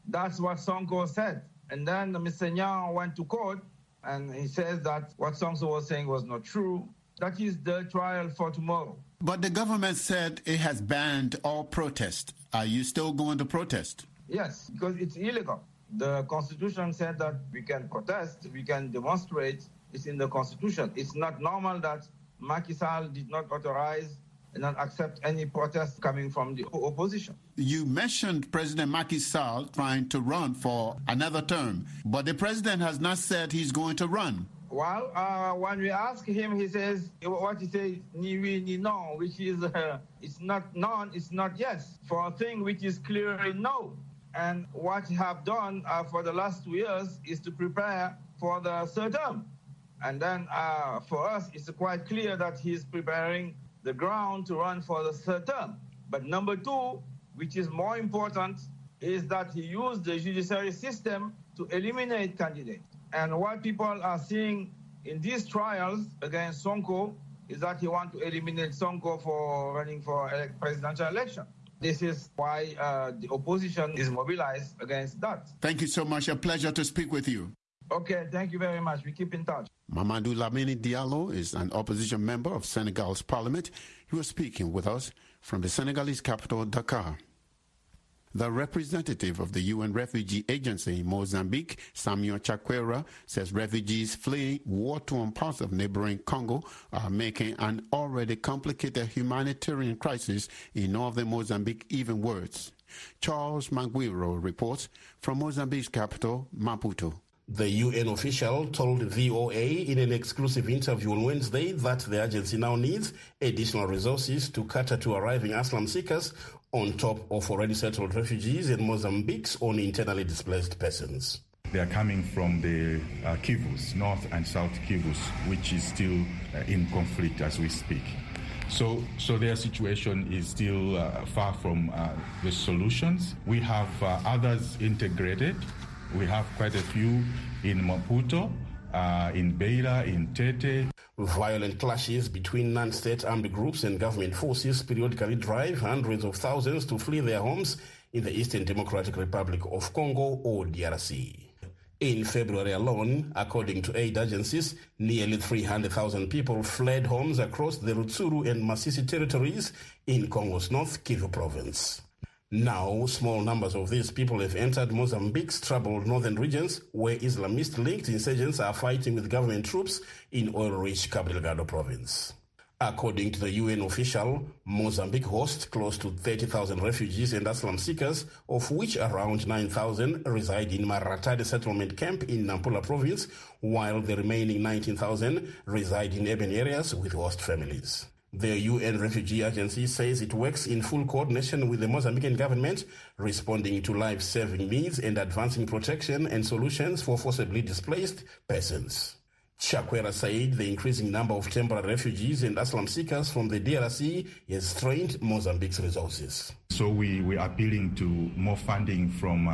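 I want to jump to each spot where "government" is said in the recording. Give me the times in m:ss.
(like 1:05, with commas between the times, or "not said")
0:09, 2:23, 2:49, 3:12.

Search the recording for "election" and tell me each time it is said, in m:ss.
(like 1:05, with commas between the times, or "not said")
1:11.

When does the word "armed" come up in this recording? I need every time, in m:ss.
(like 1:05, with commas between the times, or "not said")
2:23.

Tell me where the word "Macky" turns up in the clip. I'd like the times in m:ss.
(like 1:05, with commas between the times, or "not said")
0:22, 0:28.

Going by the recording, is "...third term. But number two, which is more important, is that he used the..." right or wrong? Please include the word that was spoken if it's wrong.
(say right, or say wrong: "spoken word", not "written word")
right.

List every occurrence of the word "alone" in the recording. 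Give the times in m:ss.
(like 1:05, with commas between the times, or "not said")
2:32.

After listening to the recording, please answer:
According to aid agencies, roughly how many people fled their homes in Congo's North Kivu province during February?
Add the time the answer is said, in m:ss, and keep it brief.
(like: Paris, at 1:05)
300,000, at 2:35.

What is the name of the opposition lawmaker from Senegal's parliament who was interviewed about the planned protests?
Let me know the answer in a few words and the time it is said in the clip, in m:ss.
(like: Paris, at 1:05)
Mamadou Lamine Diallo, at 1:19.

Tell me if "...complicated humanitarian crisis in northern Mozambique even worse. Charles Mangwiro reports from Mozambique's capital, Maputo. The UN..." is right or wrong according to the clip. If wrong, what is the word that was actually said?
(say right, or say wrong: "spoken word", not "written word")
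right.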